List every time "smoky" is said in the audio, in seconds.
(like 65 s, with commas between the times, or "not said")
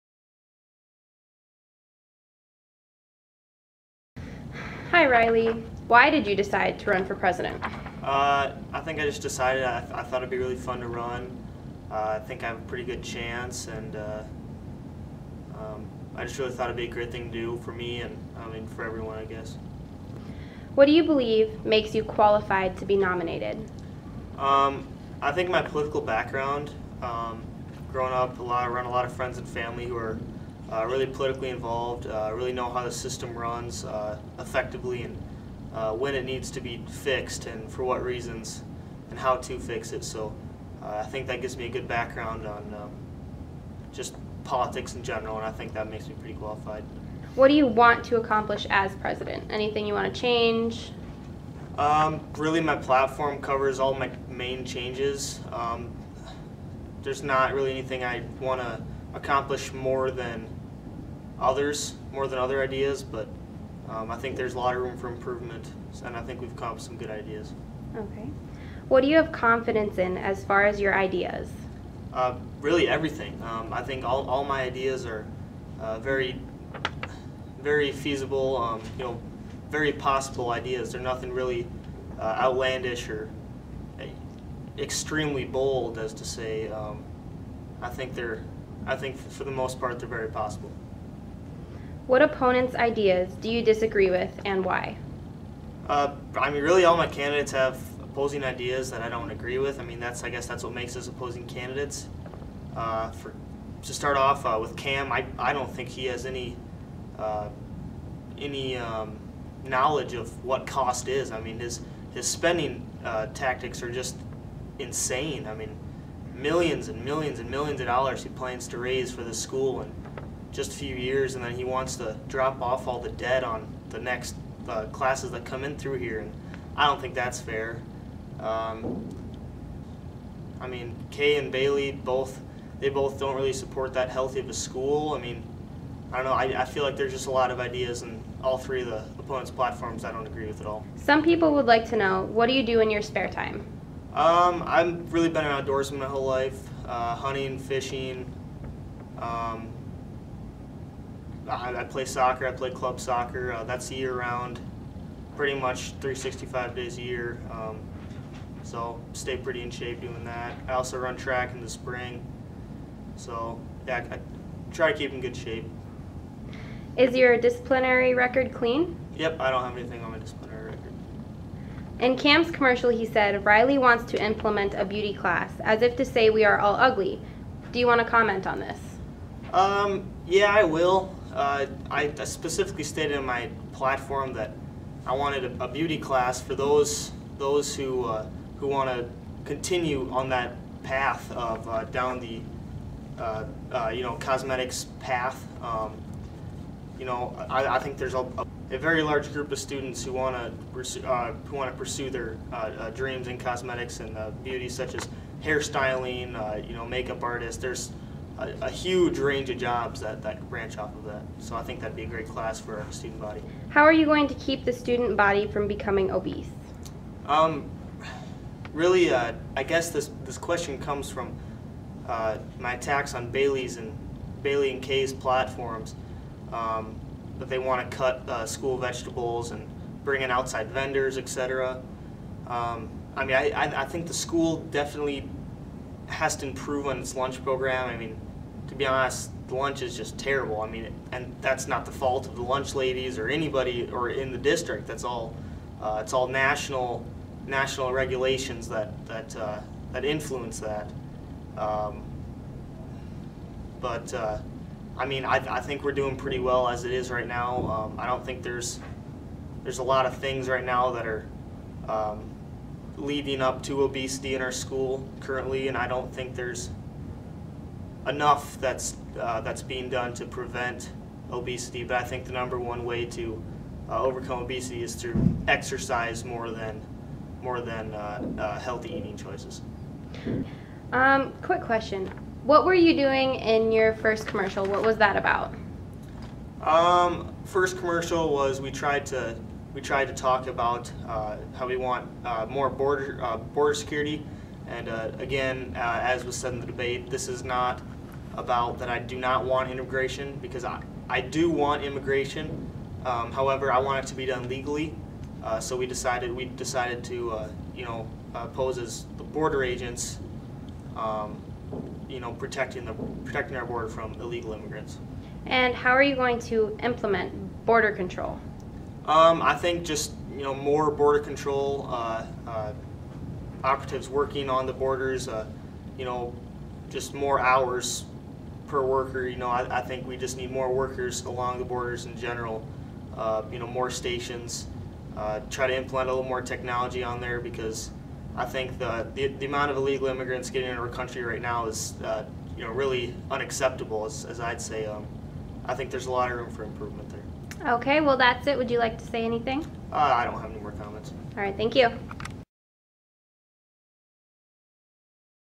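not said.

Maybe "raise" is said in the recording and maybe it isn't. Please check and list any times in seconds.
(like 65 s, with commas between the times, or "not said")
118 s.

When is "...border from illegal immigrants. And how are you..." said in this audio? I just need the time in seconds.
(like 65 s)
313 s.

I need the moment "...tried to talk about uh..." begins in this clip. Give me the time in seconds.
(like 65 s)
289 s.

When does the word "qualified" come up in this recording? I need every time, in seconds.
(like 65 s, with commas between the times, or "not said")
22 s, 46 s.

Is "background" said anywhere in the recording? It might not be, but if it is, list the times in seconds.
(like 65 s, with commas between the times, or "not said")
26 s, 41 s.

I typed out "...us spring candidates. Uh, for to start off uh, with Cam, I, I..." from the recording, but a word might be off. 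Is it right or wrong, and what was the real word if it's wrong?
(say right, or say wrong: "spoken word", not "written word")
wrong: "opposing", not "spring".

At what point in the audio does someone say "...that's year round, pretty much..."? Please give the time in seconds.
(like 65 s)
153 s.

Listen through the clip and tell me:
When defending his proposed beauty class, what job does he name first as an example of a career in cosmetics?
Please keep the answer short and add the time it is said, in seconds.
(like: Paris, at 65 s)
Hairstyling, at 205 s.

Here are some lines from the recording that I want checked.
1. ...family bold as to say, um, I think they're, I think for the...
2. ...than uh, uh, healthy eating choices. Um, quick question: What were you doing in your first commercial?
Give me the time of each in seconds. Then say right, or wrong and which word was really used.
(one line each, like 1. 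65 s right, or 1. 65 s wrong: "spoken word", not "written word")
1. 84 s wrong: "extremely", not "family"
2. 277 s right.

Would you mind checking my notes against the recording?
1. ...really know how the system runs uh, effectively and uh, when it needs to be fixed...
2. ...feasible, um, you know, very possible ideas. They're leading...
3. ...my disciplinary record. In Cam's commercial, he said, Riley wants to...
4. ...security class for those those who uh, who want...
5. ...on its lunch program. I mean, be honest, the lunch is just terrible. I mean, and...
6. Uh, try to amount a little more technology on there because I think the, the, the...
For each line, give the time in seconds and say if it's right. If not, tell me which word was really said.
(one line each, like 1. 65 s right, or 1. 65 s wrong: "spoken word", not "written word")
1. 32 s right
2. 77 s wrong: "nothing", not "leading"
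3. 170 s right
4. 185 s wrong: "beauty", not "security"
5. 236 s right
6. 335 s wrong: "implement", not "amount".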